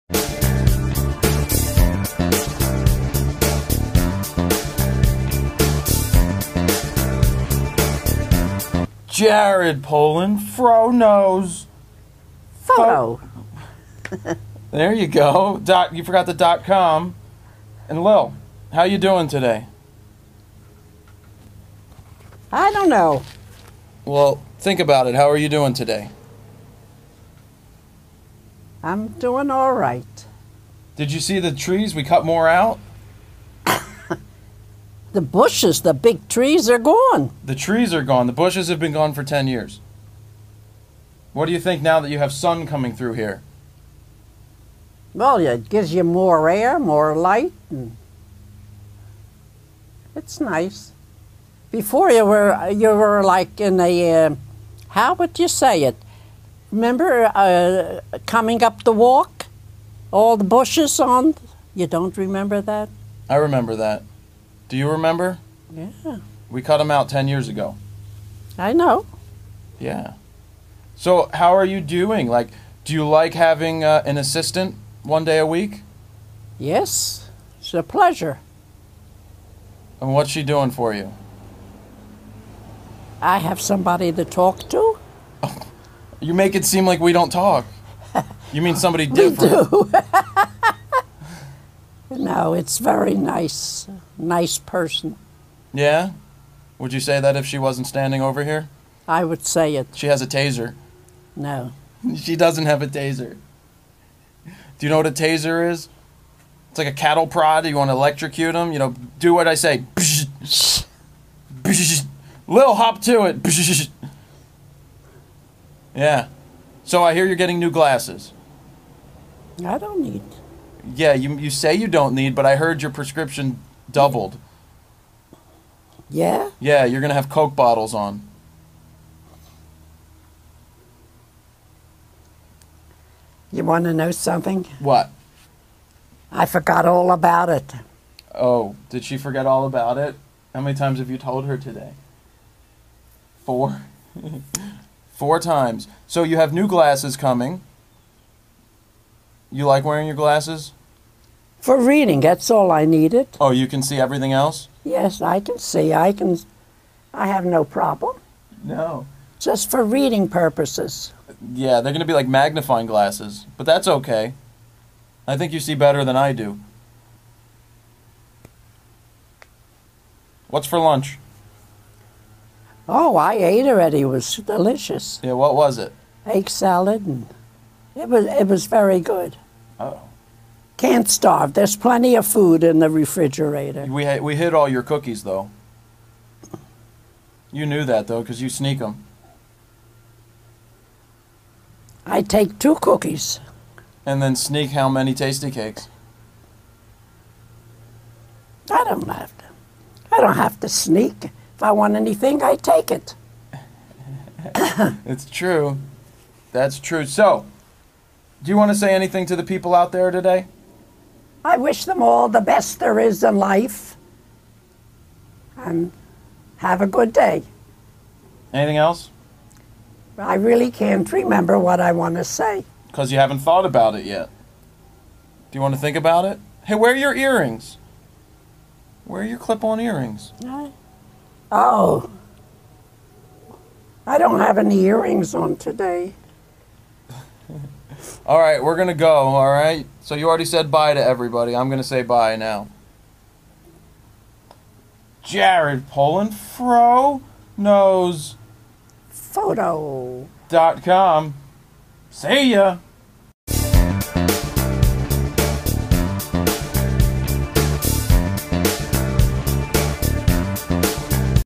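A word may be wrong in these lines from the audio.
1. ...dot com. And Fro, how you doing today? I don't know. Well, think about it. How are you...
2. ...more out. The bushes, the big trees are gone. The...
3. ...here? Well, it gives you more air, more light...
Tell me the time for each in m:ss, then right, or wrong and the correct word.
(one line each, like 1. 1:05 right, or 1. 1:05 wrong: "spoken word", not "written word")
1. 0:16 wrong: "Lil", not "Fro"
2. 0:32 right
3. 0:43 right.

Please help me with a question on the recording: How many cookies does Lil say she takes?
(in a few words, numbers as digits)
2.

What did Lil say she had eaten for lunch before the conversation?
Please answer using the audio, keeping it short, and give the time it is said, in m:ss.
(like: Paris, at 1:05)
Egg salad, at 2:56.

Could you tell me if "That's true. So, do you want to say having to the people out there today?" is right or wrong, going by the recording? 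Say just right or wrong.
wrong.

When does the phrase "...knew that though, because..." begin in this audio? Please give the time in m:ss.
3:07.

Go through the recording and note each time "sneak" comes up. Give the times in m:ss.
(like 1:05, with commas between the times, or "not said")
3:08, 3:14, 3:20.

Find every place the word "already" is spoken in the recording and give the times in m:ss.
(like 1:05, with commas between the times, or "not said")
2:53, 4:00.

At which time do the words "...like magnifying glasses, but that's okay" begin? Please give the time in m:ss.
2:42.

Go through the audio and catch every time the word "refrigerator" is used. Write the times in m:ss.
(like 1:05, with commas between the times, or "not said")
3:02.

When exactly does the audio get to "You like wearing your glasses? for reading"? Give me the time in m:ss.
2:29.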